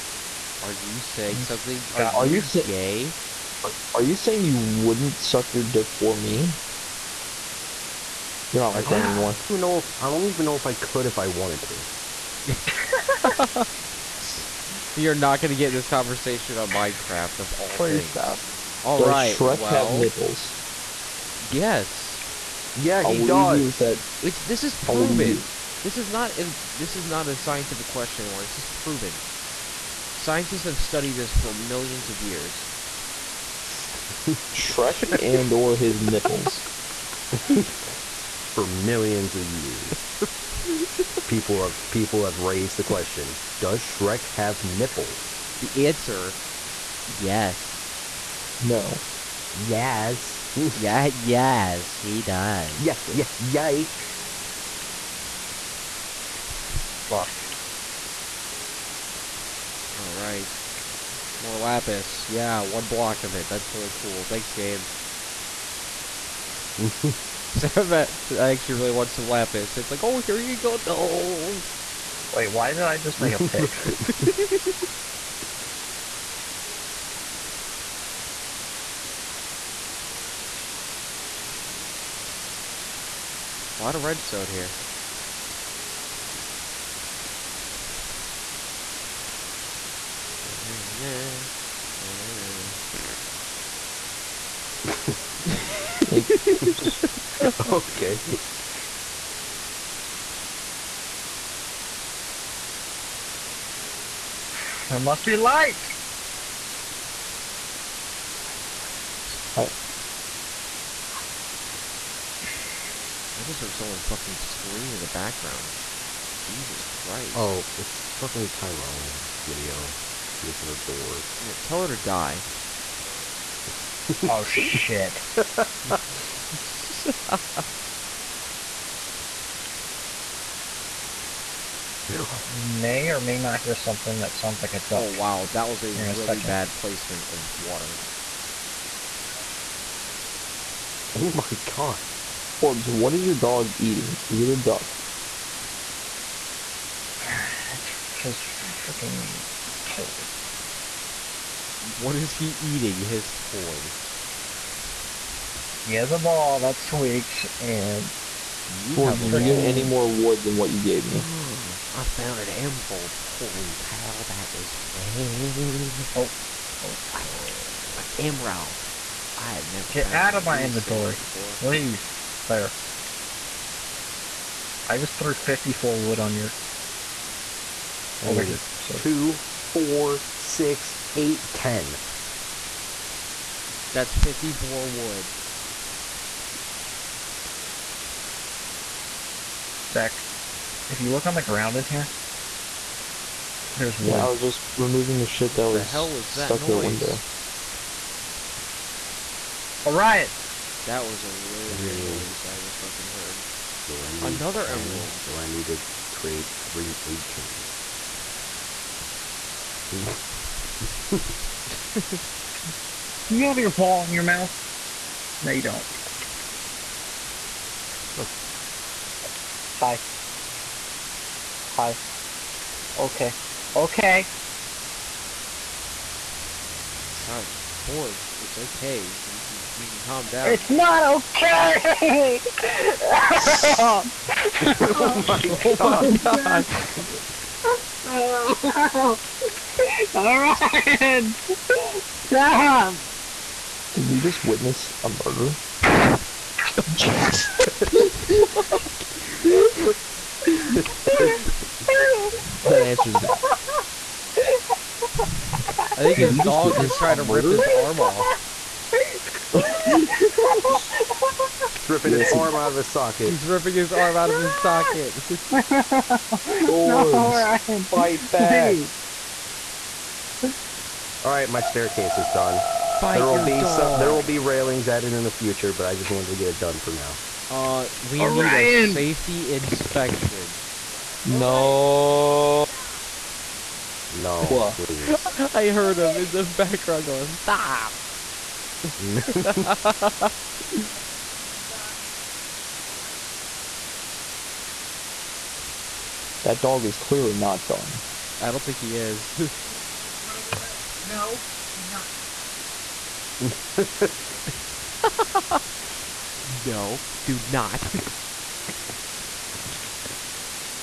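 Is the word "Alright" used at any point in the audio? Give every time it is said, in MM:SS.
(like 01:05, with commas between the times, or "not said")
00:59, 04:00.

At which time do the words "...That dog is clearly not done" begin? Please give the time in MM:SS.
04:56.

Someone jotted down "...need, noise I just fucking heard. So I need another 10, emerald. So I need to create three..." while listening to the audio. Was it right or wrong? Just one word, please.
right.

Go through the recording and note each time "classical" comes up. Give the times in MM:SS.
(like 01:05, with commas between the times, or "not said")
not said.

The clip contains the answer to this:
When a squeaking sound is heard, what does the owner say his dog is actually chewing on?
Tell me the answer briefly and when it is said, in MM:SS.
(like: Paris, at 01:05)
a ball that squeaks, at 02:36.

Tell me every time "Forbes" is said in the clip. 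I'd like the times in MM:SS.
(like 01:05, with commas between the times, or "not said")
02:22, 03:47.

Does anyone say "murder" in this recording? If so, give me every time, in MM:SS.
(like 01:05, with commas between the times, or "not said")
04:05, 04:17.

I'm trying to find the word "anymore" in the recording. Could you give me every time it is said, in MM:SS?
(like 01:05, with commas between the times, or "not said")
00:09, 00:28.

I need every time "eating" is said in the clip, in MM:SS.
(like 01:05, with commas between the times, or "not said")
02:23, 02:32.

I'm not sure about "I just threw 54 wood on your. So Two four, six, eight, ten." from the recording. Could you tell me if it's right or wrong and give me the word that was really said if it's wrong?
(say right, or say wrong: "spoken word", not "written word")
right.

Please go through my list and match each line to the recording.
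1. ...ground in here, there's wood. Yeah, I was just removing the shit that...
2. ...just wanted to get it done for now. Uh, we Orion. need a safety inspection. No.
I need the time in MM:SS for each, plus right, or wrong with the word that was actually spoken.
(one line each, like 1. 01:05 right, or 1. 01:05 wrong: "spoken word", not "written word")
1. 03:11 right
2. 04:35 right.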